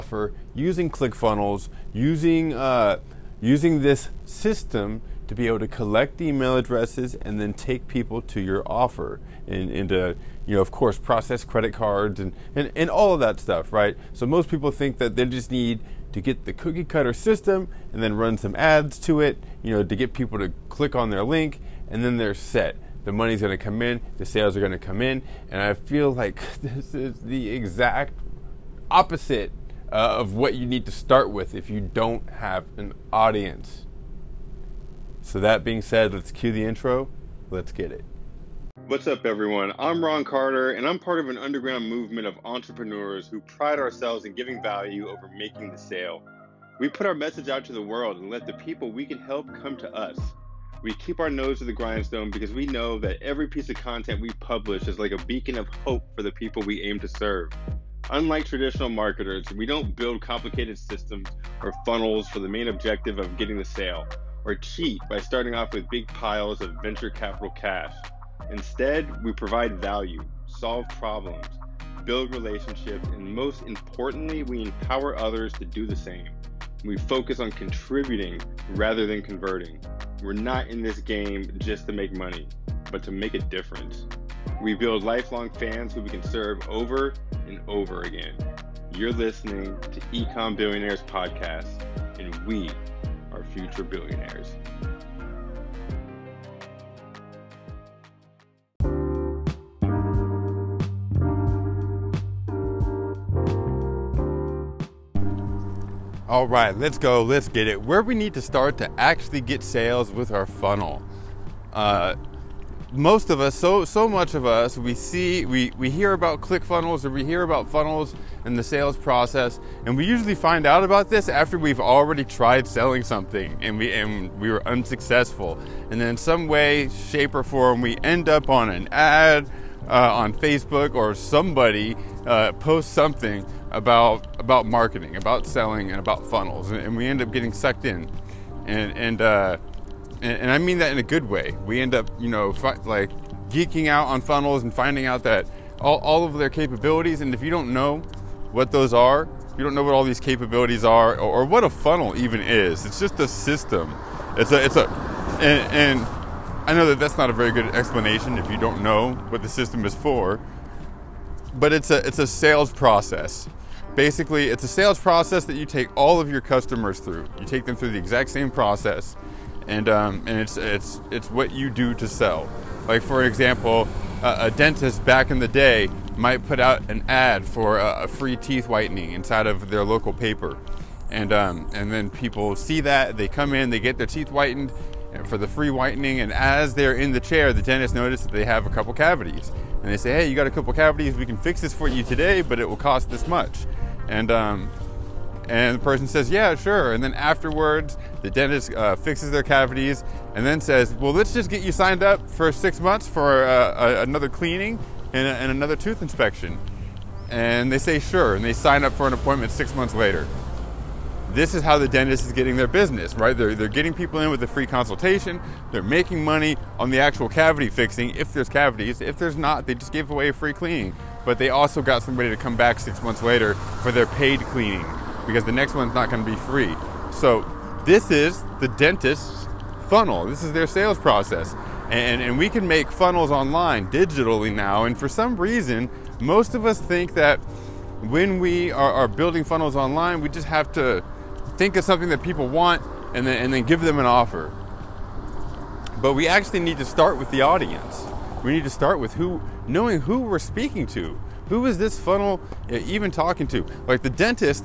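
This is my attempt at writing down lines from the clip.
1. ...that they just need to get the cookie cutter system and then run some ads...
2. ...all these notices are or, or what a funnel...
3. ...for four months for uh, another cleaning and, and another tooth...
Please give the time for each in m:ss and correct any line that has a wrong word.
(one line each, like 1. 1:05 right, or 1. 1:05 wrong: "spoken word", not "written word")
1. 0:14 right
2. 2:29 wrong: "capabilities", not "notices"
3. 3:22 wrong: "six", not "four".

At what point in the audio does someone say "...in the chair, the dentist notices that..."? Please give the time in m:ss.
3:06.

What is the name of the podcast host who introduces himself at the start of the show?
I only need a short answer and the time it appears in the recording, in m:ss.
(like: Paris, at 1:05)
Ron Carter, at 0:40.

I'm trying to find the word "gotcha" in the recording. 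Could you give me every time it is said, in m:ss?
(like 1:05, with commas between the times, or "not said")
not said.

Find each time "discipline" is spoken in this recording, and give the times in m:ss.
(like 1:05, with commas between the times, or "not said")
not said.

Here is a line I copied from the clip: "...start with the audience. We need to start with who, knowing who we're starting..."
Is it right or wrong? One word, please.
wrong.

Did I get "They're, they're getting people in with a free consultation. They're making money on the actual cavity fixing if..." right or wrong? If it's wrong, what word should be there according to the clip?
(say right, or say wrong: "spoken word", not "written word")
right.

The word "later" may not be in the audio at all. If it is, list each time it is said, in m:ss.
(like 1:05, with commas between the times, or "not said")
3:29, 3:43.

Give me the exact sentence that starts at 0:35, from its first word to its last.
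So, that being said, let's cue the intro.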